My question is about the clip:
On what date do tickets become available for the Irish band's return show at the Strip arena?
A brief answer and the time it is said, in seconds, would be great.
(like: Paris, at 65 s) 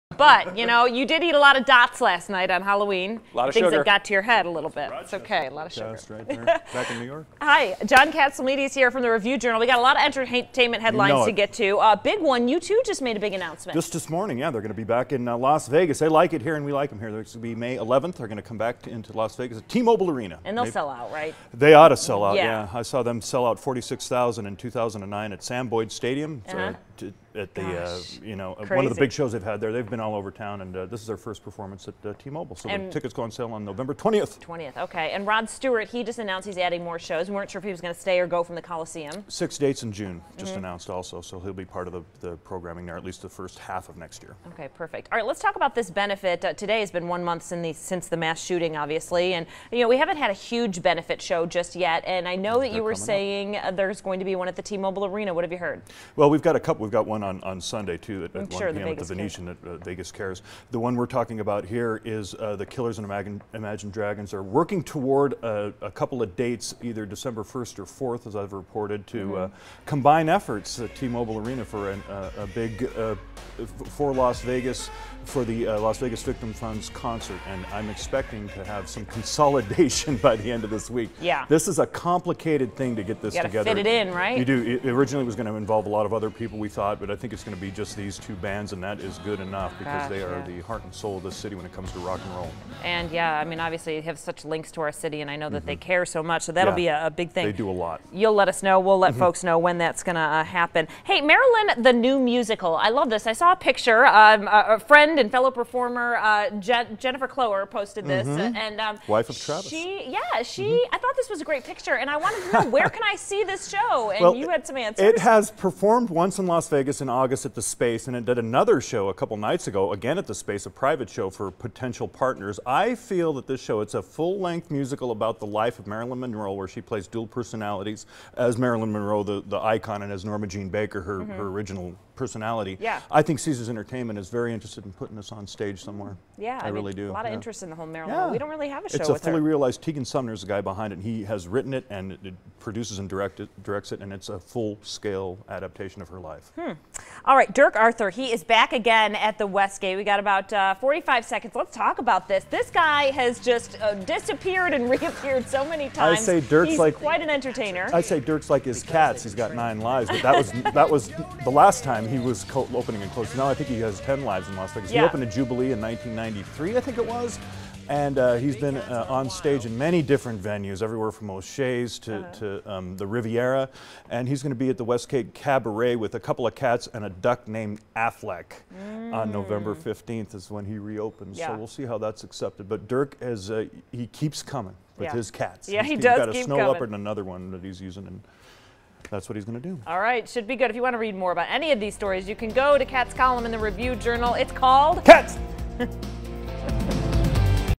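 November 20th, at 33 s.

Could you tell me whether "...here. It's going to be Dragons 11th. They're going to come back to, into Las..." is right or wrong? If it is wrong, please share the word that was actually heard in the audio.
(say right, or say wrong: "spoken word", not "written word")
wrong: "May", not "Dragons".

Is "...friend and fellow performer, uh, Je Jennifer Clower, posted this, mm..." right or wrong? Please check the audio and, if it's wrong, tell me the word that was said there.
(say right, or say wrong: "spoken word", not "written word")
right.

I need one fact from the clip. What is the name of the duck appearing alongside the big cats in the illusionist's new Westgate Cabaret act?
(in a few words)
Affleck.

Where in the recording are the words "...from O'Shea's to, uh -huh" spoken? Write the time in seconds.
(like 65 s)
171 s.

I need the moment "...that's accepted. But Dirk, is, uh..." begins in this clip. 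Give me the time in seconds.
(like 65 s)
181 s.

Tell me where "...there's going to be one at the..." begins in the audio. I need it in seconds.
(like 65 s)
53 s.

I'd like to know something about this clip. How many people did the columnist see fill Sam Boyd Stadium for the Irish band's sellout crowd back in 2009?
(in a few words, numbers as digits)
46,000.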